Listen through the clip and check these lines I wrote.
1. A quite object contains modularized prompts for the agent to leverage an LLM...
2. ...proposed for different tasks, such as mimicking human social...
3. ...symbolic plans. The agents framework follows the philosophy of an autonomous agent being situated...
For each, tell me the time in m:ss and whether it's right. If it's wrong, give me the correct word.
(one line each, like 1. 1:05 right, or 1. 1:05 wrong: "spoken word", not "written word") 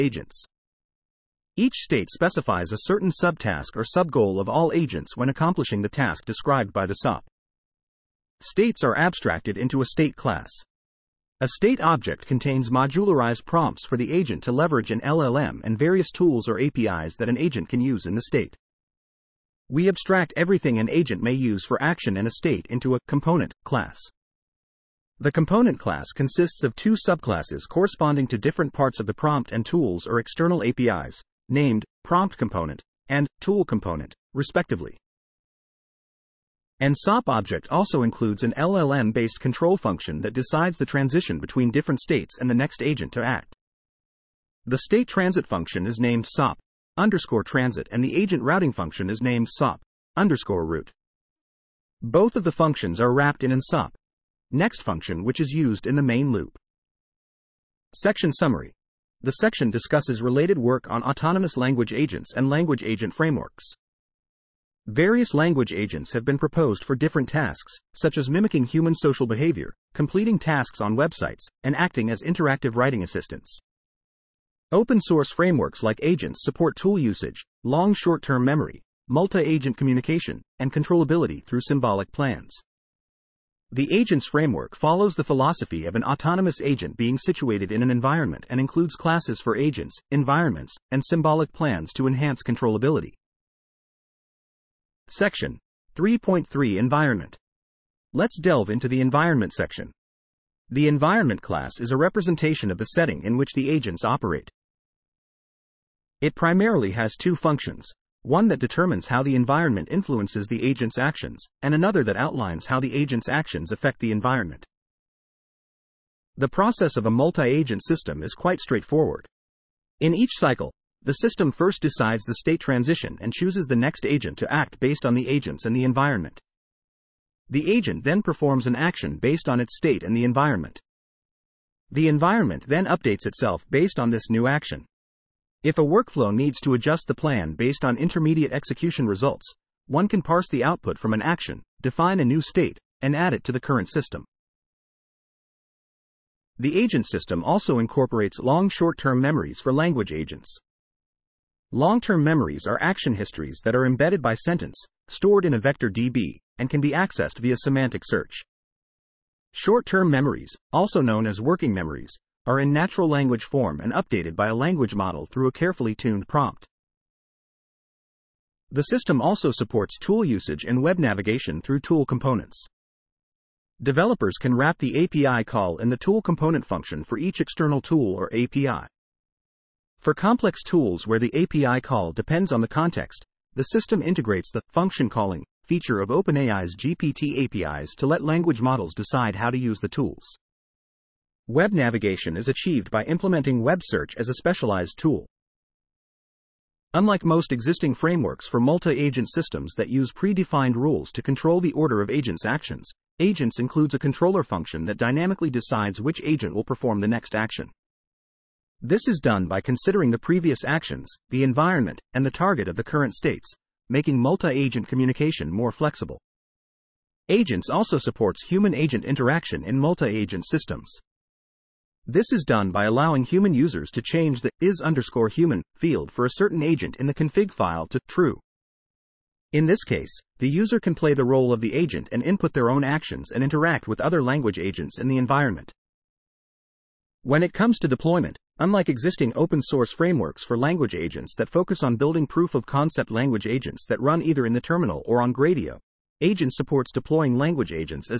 1. 0:11 wrong: "state", not "quite"
2. 1:06 right
3. 1:21 right.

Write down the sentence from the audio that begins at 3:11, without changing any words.
Web navigation is achieved by implementing web search as a specialized tool.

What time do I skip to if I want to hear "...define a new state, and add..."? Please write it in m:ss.
2:21.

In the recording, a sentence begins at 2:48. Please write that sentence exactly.
The system also supports tool usage and web navigation through tool components.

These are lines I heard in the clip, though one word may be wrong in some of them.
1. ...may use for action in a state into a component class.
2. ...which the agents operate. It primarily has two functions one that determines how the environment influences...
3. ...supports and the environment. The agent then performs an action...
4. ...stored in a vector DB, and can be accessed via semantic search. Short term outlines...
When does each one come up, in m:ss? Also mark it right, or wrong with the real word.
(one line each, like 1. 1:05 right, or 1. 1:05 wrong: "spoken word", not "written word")
1. 0:21 right
2. 1:43 right
3. 2:05 wrong: "agents", not "supports"
4. 2:35 wrong: "memories", not "outlines".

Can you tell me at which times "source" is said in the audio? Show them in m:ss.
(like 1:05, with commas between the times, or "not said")
1:15, 3:59.